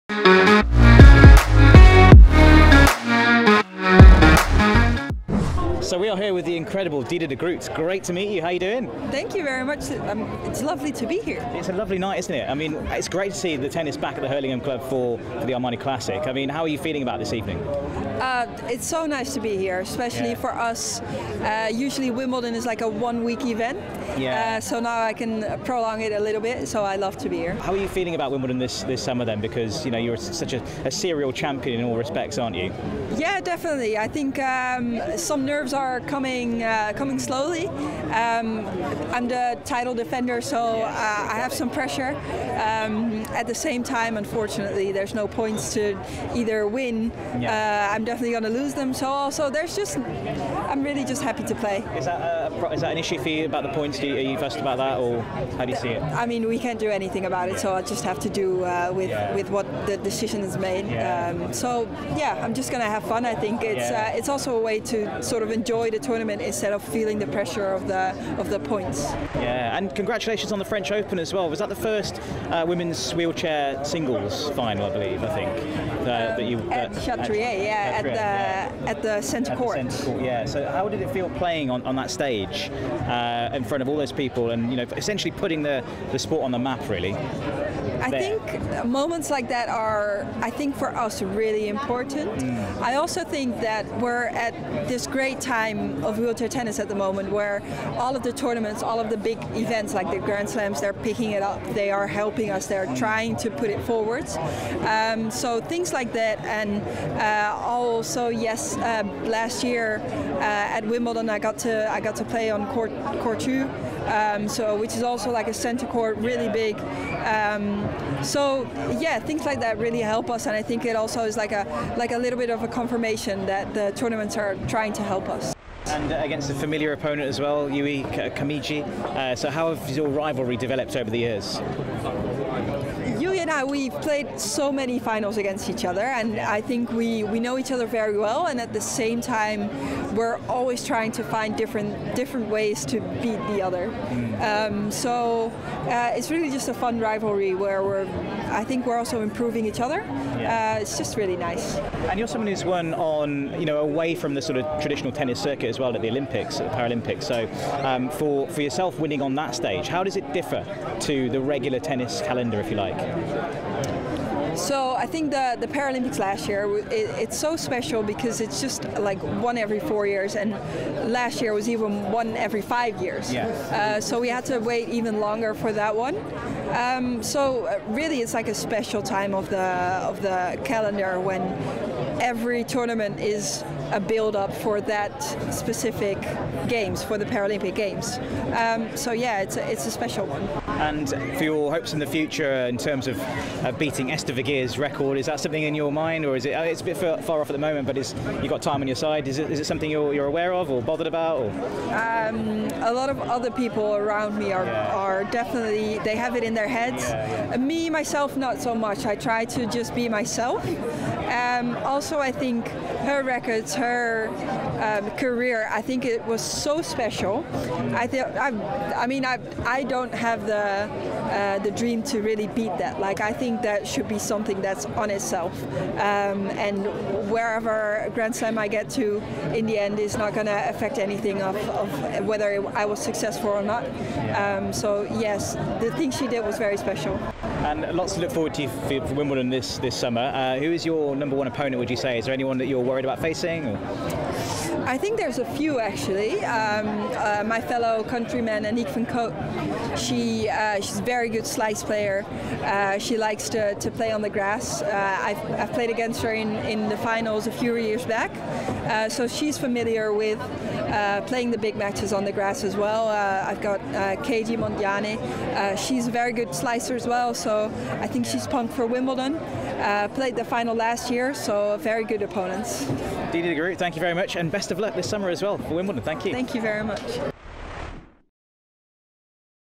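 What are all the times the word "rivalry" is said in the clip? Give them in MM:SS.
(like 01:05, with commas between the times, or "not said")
02:10, 02:26.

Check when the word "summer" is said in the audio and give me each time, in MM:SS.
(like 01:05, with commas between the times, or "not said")
00:29, 03:59, 04:35.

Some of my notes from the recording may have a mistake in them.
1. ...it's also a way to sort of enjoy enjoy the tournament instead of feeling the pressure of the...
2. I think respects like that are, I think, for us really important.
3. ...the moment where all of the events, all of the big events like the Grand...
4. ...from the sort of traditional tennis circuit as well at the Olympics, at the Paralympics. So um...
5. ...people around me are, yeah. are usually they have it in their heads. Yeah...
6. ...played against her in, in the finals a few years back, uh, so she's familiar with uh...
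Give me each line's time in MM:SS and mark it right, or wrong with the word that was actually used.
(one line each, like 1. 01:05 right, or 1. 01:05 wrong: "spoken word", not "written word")
1. 01:04 right
2. 01:28 wrong: "moments", not "respects"
3. 01:36 wrong: "tournaments", not "events"
4. 02:34 right
5. 03:23 wrong: "definitely", not "usually"
6. 04:15 right.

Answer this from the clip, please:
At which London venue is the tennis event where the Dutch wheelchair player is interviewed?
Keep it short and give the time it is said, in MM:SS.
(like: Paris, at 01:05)
Hurlingham Club, at 00:14.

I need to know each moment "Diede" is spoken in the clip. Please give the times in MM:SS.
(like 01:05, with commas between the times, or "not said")
00:07, 04:33.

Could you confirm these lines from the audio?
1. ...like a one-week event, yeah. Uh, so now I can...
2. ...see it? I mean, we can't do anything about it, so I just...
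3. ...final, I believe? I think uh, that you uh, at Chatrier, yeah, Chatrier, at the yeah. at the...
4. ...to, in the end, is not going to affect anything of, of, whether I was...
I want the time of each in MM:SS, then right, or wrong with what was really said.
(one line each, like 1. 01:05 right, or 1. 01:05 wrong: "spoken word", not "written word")
1. 00:22 right
2. 00:55 right
3. 01:14 right
4. 03:48 right.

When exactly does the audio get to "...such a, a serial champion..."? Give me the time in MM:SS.
00:30.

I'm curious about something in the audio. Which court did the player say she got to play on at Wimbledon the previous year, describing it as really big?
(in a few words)
Court Two.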